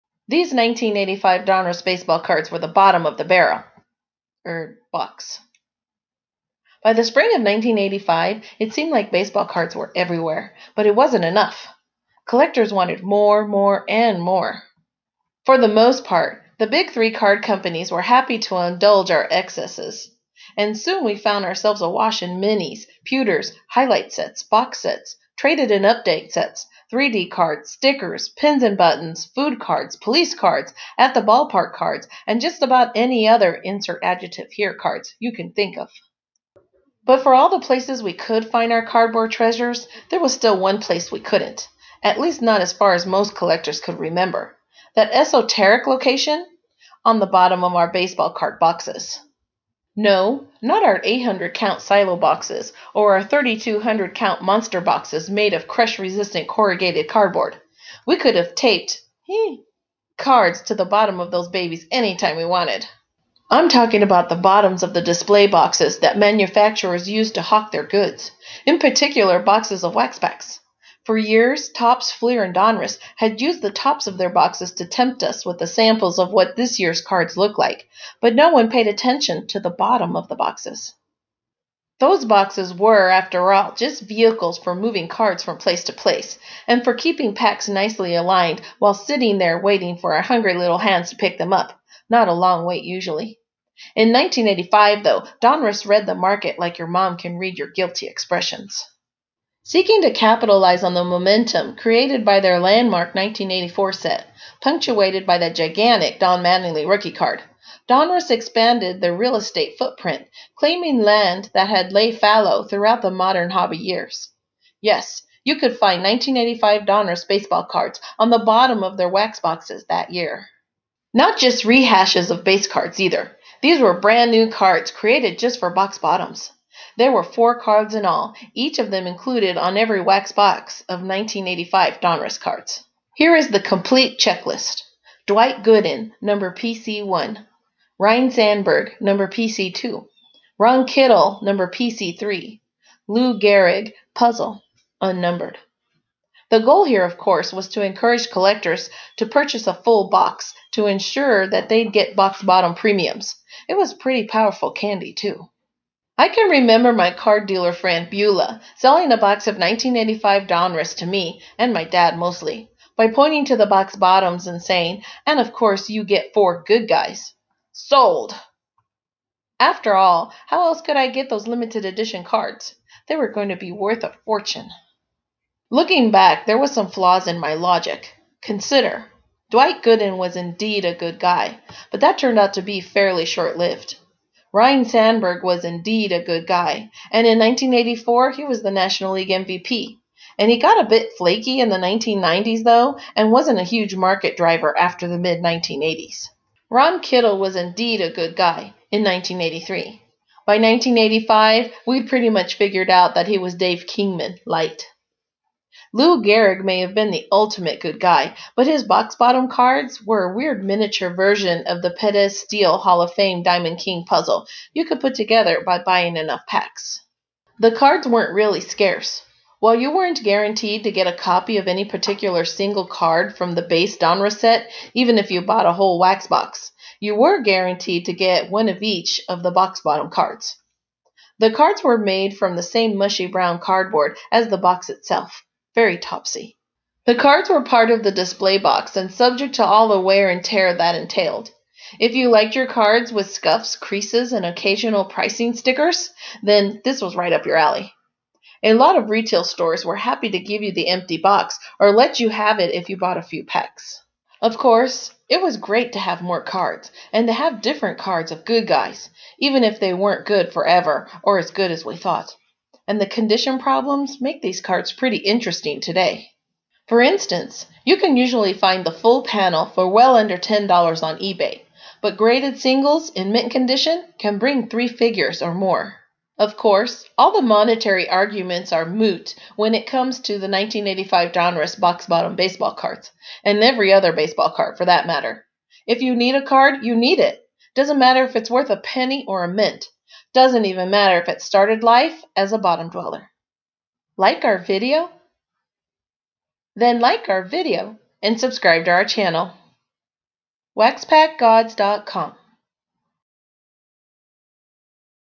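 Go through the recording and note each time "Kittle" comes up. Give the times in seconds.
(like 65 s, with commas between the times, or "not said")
140 s, 196 s.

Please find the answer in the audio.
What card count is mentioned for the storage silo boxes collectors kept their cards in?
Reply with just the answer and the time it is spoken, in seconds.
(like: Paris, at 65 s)
800, at 51 s.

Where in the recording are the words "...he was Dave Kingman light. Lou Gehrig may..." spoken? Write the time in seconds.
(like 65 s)
203 s.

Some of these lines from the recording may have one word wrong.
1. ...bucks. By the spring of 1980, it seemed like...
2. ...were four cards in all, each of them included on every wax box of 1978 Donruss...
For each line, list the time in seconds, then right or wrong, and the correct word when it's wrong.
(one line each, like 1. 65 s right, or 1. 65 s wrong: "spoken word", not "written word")
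1. 4 s wrong: "1985", not "1980"
2. 127 s wrong: "1985", not "1978".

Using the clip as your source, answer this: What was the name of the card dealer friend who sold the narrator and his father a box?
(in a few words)
Beulah.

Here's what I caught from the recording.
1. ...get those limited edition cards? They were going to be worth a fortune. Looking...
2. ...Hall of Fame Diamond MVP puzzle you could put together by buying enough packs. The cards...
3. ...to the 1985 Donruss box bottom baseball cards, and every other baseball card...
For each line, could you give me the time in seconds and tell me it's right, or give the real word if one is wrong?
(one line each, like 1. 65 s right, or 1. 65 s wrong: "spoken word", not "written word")
1. 171 s right
2. 212 s wrong: "King", not "MVP"
3. 280 s right.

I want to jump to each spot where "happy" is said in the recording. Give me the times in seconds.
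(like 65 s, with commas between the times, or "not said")
18 s, 249 s.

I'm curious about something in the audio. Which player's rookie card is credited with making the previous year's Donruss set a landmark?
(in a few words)
Don Mattingly.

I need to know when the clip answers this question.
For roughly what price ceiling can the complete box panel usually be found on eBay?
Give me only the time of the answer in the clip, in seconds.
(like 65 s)
270 s.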